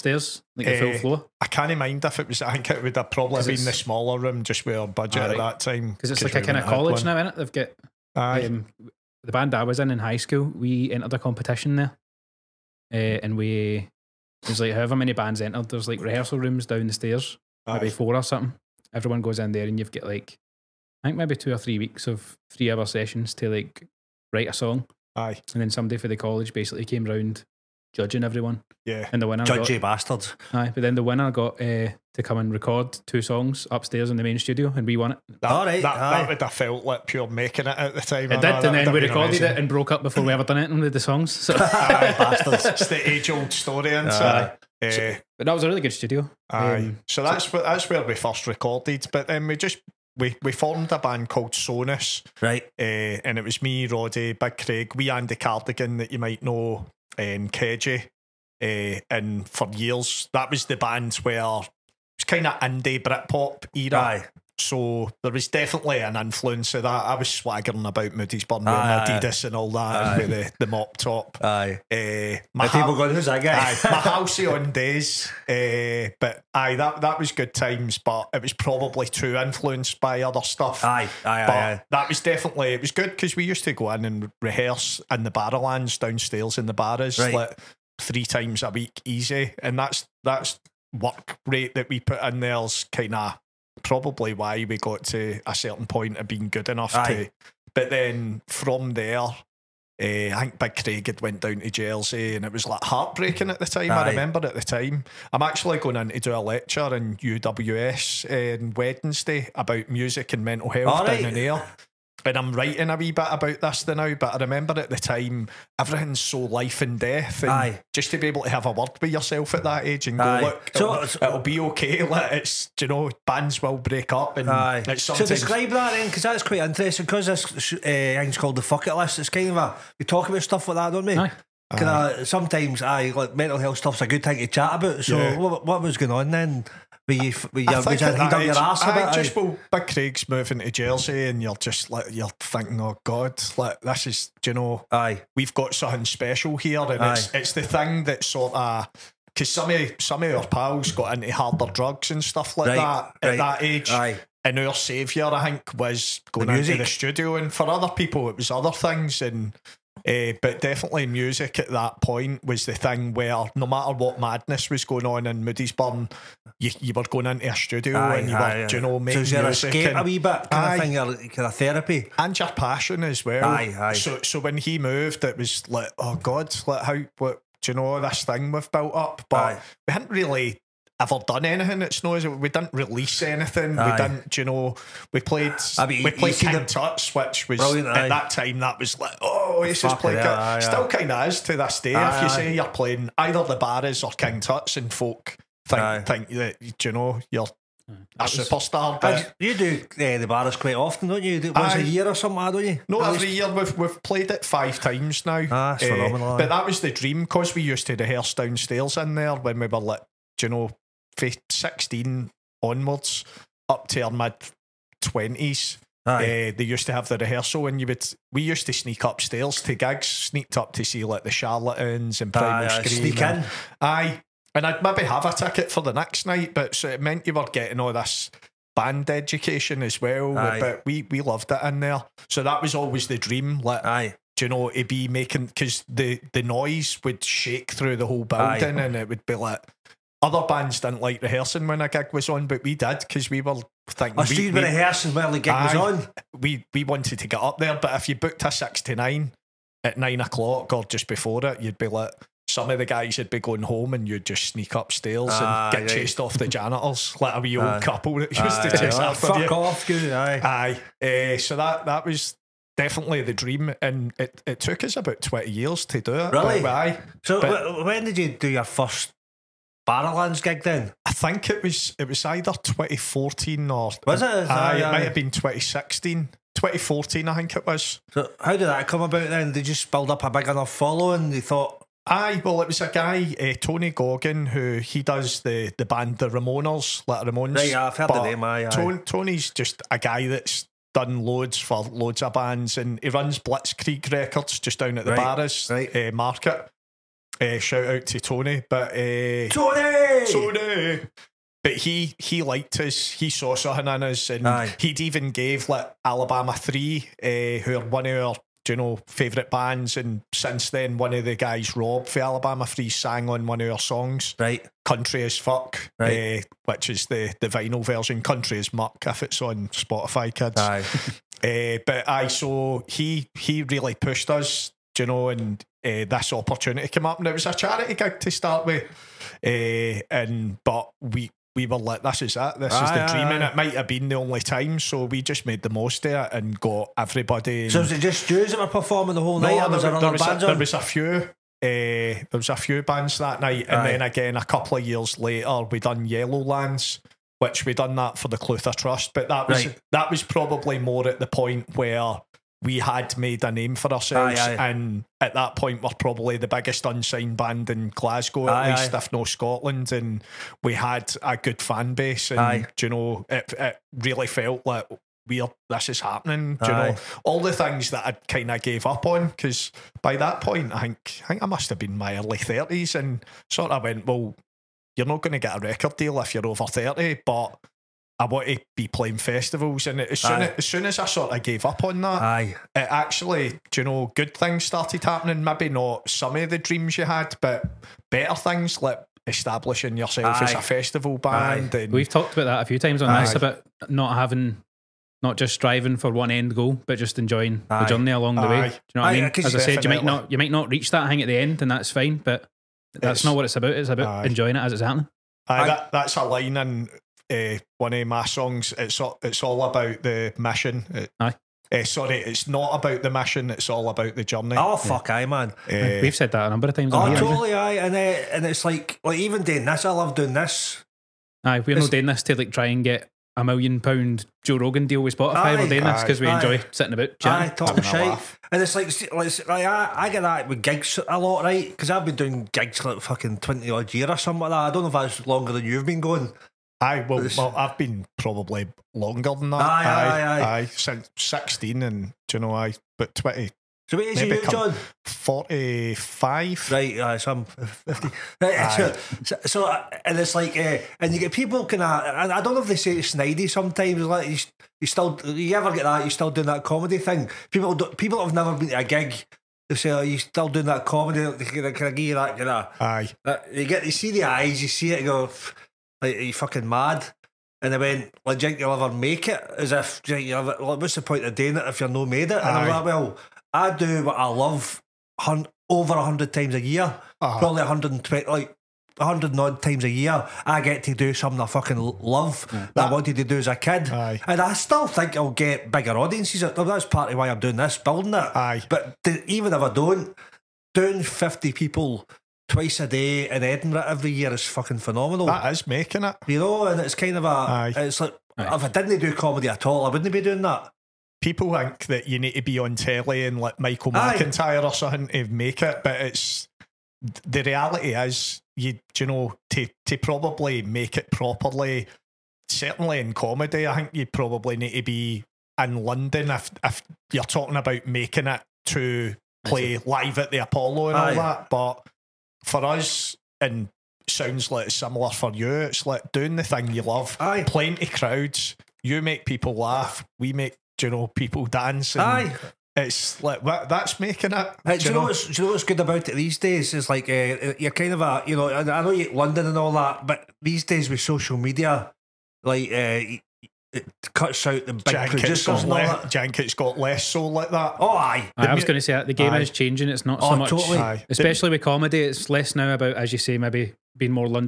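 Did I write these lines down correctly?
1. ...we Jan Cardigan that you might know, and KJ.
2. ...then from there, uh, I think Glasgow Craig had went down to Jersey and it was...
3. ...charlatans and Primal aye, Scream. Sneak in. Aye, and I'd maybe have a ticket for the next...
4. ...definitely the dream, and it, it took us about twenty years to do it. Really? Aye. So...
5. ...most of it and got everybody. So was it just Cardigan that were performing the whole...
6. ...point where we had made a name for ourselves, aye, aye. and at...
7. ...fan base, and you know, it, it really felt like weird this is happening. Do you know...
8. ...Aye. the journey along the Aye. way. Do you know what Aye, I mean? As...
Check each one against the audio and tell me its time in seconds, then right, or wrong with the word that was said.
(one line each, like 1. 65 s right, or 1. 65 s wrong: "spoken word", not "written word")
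1. 54 s wrong: "Andy", not "Jan"
2. 97 s wrong: "Big", not "Glasgow"
3. 221 s right
4. 262 s right
5. 335 s wrong: "Jews", not "Cardigan"
6. 351 s right
7. 361 s right
8. 397 s right.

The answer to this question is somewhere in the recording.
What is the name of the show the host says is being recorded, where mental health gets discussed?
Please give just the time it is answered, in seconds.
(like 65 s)
128 s.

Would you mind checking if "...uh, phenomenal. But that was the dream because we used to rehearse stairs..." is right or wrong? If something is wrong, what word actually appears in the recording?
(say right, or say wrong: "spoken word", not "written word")
wrong: "downstairs", not "stairs".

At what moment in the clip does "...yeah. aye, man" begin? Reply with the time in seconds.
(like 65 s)
415 s.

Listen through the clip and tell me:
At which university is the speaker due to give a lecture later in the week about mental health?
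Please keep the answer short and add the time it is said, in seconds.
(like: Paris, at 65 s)
UWS, at 107 s.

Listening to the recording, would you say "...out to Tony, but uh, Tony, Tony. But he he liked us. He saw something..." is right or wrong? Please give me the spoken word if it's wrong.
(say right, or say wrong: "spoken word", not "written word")
right.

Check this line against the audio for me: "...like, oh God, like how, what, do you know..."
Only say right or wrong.
right.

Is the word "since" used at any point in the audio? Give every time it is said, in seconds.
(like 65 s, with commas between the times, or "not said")
310 s, 440 s.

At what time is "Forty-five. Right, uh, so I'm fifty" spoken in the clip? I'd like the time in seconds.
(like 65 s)
445 s.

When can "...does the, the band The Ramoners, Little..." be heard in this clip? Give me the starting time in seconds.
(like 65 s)
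285 s.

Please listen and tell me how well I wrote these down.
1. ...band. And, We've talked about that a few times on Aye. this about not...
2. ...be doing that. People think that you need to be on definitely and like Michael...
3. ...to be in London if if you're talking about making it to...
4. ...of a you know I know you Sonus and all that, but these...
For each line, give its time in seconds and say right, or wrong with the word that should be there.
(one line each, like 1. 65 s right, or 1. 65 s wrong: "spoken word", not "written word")
1. 391 s right
2. 500 s wrong: "telly", not "definitely"
3. 514 s right
4. 537 s wrong: "London", not "Sonus".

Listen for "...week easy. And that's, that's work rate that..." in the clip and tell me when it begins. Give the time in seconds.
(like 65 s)
88 s.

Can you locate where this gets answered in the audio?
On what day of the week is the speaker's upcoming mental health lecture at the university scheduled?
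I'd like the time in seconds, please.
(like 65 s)
108 s.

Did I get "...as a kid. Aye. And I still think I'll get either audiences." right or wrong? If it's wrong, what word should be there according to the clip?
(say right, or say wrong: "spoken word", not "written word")
wrong: "bigger", not "either".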